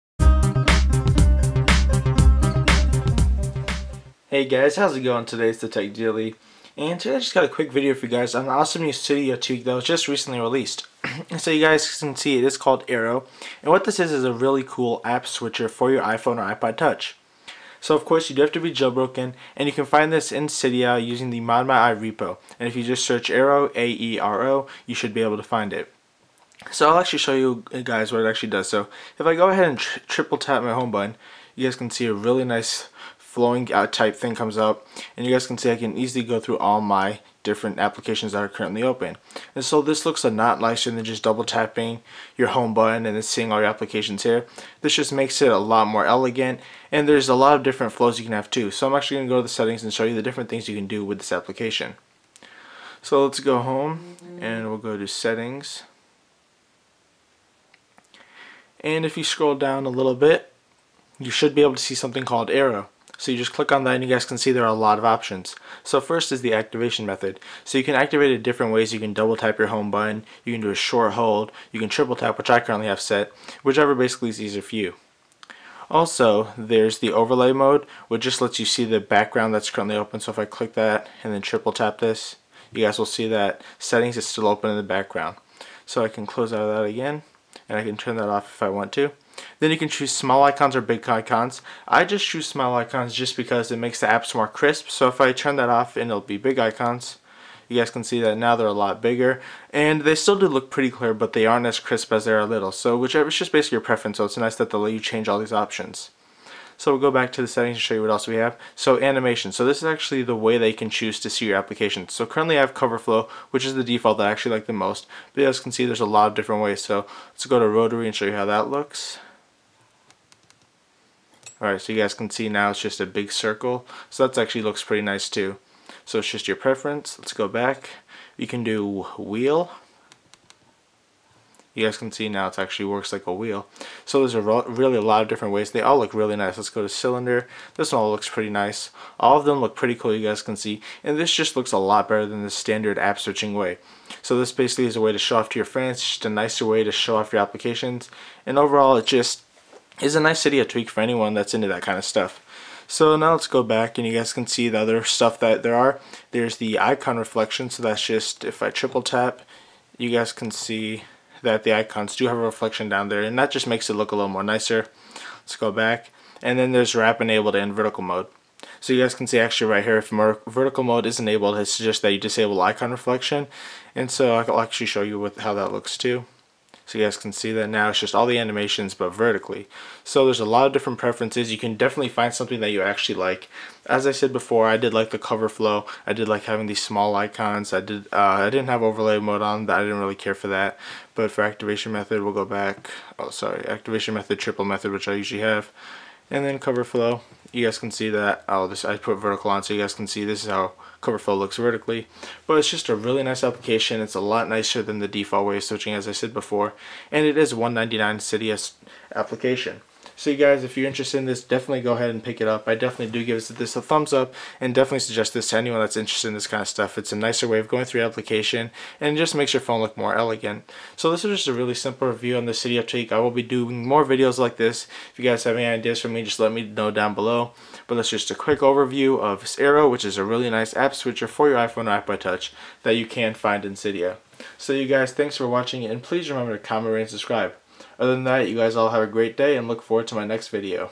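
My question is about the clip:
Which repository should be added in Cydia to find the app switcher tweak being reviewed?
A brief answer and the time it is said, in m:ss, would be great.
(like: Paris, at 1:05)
ModMyI, at 0:21.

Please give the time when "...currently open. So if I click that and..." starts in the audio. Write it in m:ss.
1:19.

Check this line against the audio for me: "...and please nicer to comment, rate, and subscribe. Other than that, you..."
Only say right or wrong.
wrong.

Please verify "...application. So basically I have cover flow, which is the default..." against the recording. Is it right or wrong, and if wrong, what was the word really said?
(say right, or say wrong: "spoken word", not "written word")
wrong: "currently", not "basically".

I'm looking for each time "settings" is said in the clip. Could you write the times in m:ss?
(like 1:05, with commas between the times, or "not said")
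0:49, 0:55, 1:23, 1:47.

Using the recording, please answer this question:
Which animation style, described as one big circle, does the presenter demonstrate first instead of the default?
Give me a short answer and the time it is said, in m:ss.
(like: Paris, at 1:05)
Rotary, at 1:57.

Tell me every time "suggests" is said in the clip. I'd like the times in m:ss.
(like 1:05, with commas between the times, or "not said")
2:51, 3:34.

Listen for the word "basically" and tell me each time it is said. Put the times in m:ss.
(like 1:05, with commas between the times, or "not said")
1:13, 1:43, 2:24.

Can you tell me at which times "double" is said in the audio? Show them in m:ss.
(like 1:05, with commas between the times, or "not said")
0:41, 1:09.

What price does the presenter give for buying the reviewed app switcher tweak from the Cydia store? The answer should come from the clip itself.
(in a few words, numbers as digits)
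$1.99.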